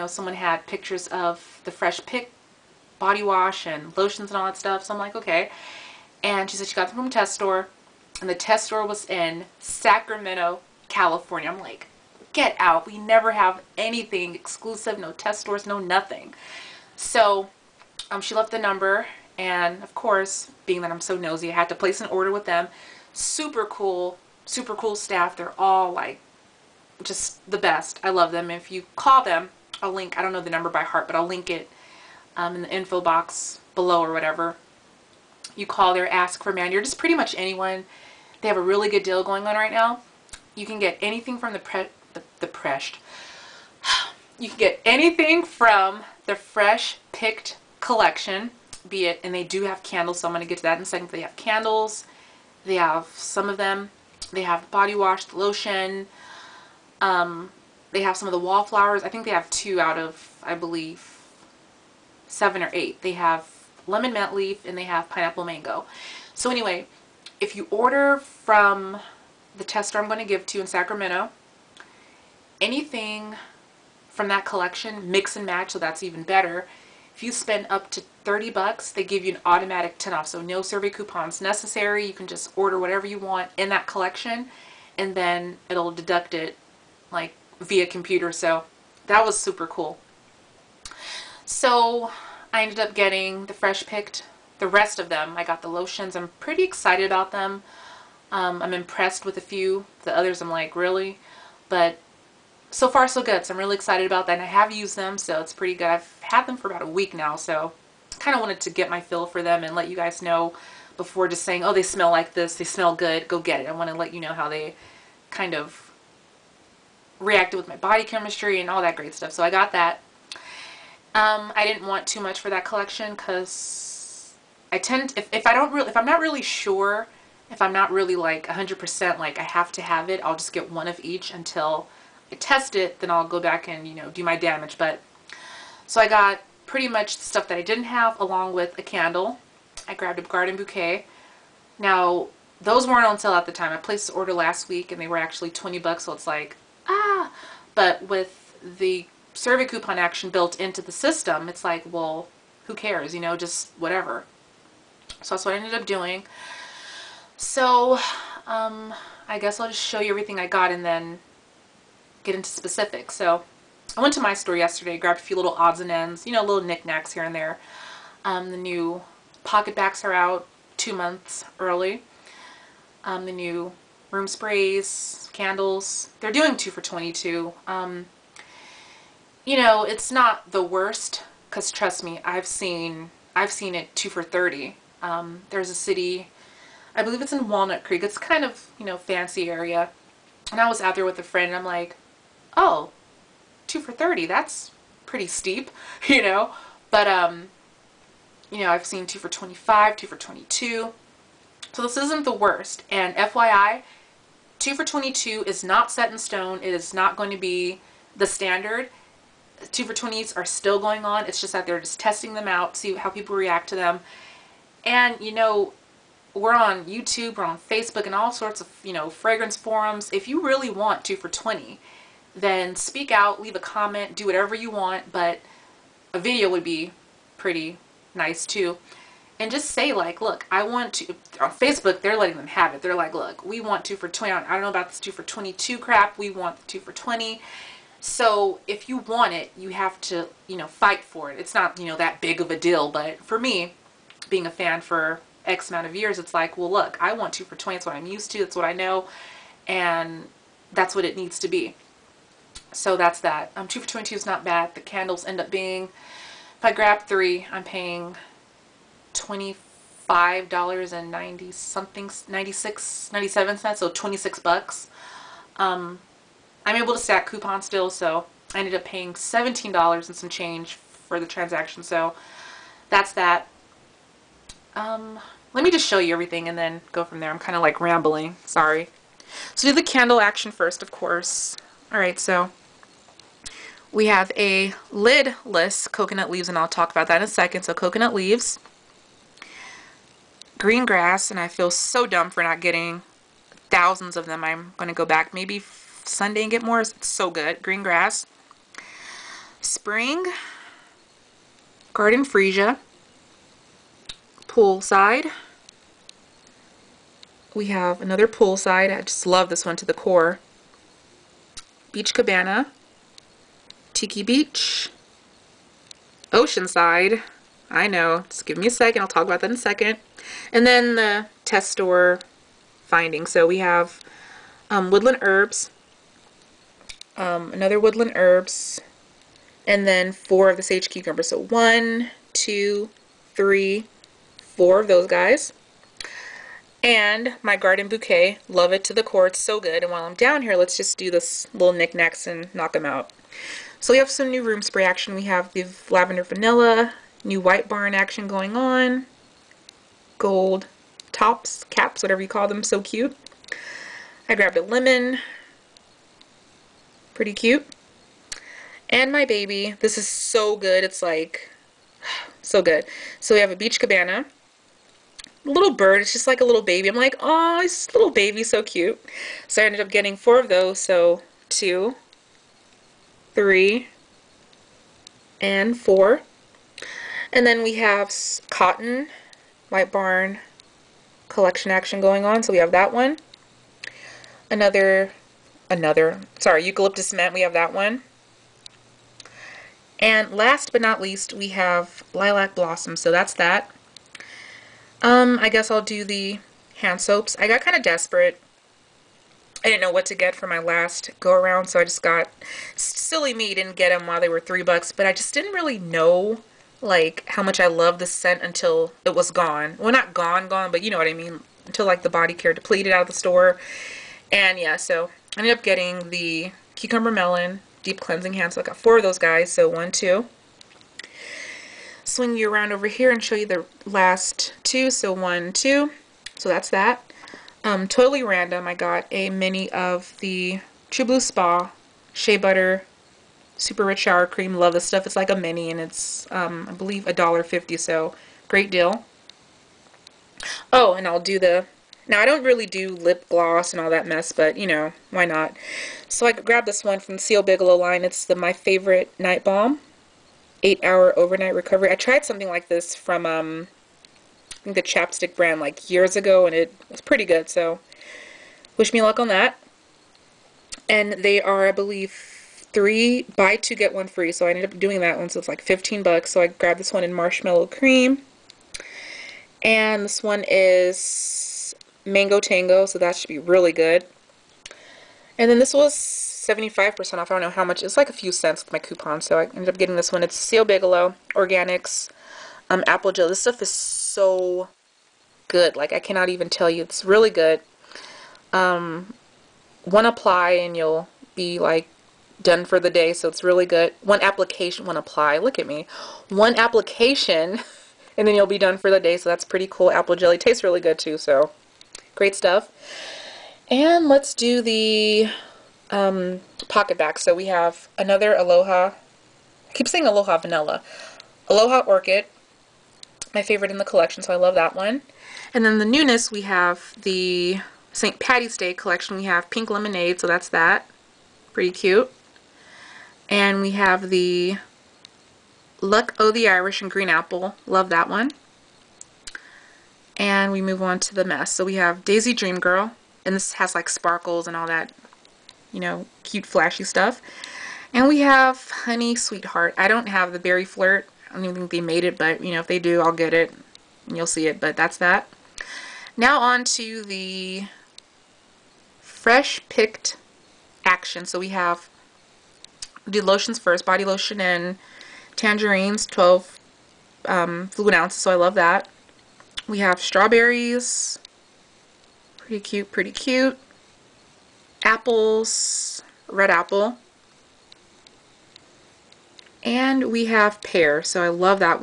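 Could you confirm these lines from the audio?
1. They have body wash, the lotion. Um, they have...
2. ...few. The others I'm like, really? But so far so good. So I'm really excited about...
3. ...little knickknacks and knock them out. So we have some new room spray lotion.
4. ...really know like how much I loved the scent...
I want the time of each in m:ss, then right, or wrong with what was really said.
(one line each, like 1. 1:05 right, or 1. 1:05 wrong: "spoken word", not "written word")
1. 0:54 right
2. 1:39 right
3. 5:41 wrong: "action", not "lotion"
4. 6:45 right.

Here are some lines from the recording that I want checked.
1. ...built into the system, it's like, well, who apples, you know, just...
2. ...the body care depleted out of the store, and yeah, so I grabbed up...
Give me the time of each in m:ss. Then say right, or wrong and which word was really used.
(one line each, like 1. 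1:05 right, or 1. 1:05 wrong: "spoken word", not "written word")
1. 2:30 wrong: "cares", not "apples"
2. 6:52 wrong: "ended", not "grabbed".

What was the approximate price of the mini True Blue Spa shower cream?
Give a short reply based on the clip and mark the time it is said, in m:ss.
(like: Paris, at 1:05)
$1.50, at 7:17.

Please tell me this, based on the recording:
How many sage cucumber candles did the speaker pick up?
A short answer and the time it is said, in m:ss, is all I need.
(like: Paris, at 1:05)
4, at 5:30.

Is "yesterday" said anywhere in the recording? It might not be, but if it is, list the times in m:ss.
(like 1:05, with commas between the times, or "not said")
2:44.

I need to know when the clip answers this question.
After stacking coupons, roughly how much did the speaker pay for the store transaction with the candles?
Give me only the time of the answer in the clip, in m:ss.
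4:29.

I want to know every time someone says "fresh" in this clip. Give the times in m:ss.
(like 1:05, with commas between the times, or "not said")
0:01, 0:46, 1:33, 9:08.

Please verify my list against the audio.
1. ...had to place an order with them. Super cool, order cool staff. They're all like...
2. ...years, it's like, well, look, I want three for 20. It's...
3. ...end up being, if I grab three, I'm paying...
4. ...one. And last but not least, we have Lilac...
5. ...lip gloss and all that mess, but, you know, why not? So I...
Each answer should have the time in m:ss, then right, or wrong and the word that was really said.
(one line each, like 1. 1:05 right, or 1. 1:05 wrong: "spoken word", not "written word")
1. 0:21 wrong: "super", not "order"
2. 4:05 wrong: "two", not "three"
3. 4:15 right
4. 6:27 right
5. 7:22 right.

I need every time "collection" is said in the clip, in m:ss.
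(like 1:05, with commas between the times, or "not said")
0:47, 1:14, 1:23, 2:02, 6:21, 8:33, 8:38.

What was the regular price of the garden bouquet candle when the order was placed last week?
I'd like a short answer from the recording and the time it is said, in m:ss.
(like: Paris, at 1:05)
$20, at 2:25.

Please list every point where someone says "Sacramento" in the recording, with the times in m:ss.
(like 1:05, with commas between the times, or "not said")
0:09, 1:10.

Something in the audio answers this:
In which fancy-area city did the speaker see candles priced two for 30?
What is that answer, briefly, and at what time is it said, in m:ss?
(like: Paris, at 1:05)
Walnut Creek, at 3:07.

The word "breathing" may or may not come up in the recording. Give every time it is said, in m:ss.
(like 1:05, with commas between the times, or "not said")
not said.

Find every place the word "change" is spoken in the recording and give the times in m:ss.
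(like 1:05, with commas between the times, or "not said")
4:30.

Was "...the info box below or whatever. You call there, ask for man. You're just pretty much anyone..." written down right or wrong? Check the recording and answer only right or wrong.
right.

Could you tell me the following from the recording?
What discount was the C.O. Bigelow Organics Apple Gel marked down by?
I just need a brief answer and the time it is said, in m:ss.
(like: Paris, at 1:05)
75%, at 7:56.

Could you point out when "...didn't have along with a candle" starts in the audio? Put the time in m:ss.
2:17.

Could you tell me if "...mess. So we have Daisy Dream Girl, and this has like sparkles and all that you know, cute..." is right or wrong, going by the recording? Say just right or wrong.
right.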